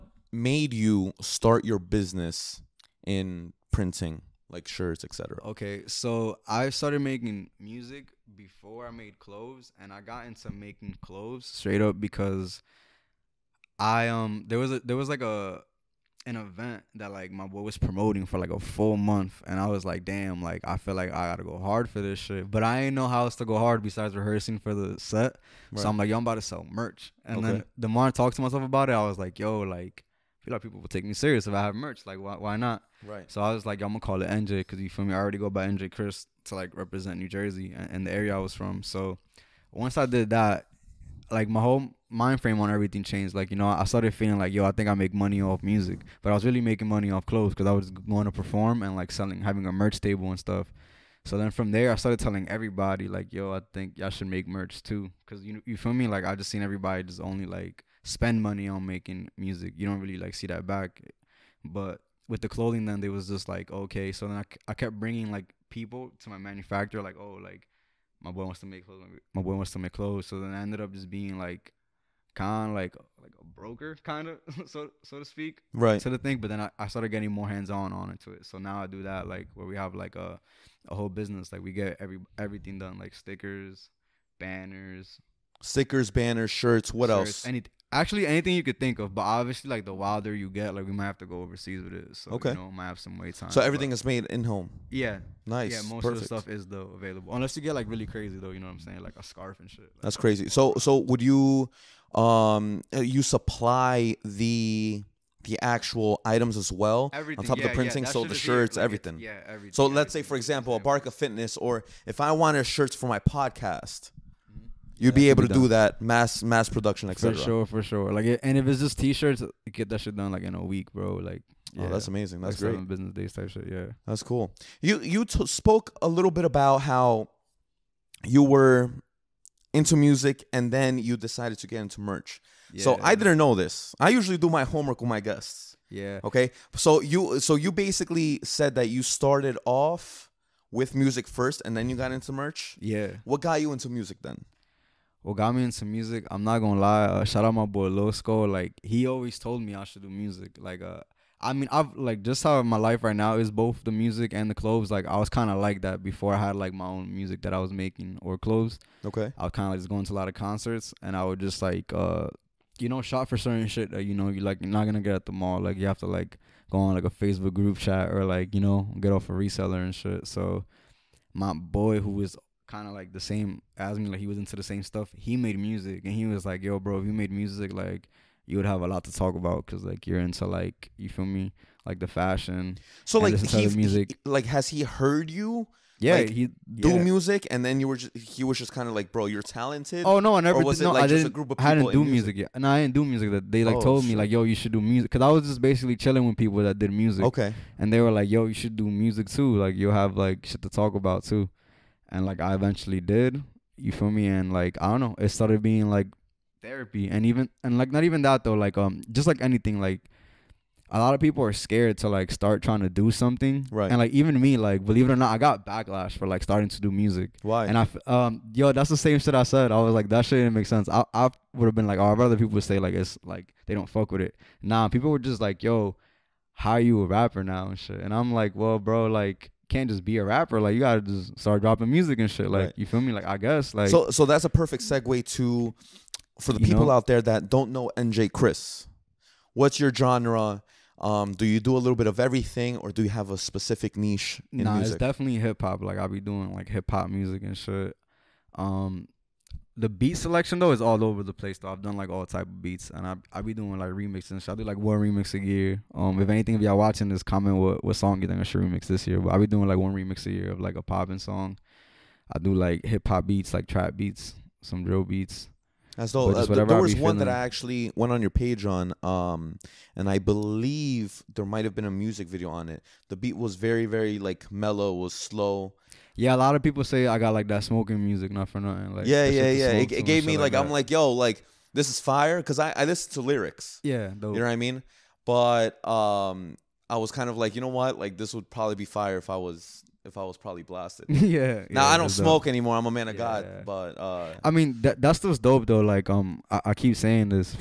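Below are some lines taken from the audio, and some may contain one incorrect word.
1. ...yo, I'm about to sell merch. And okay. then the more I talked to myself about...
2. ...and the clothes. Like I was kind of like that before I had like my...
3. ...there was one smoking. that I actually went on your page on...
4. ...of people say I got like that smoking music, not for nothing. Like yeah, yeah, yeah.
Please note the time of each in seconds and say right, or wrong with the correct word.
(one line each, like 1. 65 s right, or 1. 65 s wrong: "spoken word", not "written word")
1. 26 s right
2. 154 s right
3. 266 s wrong: "feeling", not "smoking"
4. 276 s right.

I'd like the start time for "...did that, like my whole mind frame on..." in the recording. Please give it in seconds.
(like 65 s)
40 s.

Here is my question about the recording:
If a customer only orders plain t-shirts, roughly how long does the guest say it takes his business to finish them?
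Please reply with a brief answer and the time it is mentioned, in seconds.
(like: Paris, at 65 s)
A week, at 120 s.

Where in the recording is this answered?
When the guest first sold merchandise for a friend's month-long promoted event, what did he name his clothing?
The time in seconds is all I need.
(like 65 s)
34 s.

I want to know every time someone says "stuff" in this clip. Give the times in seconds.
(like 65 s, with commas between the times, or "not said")
50 s, 96 s, 174 s.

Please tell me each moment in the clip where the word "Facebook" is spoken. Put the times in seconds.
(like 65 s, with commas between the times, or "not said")
167 s.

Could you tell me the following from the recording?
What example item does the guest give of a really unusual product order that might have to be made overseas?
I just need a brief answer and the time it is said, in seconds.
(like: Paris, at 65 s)
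A scarf, at 99 s.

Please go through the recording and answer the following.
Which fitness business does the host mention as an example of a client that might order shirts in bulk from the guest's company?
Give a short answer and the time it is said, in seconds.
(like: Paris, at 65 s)
Abarca Fitness, at 110 s.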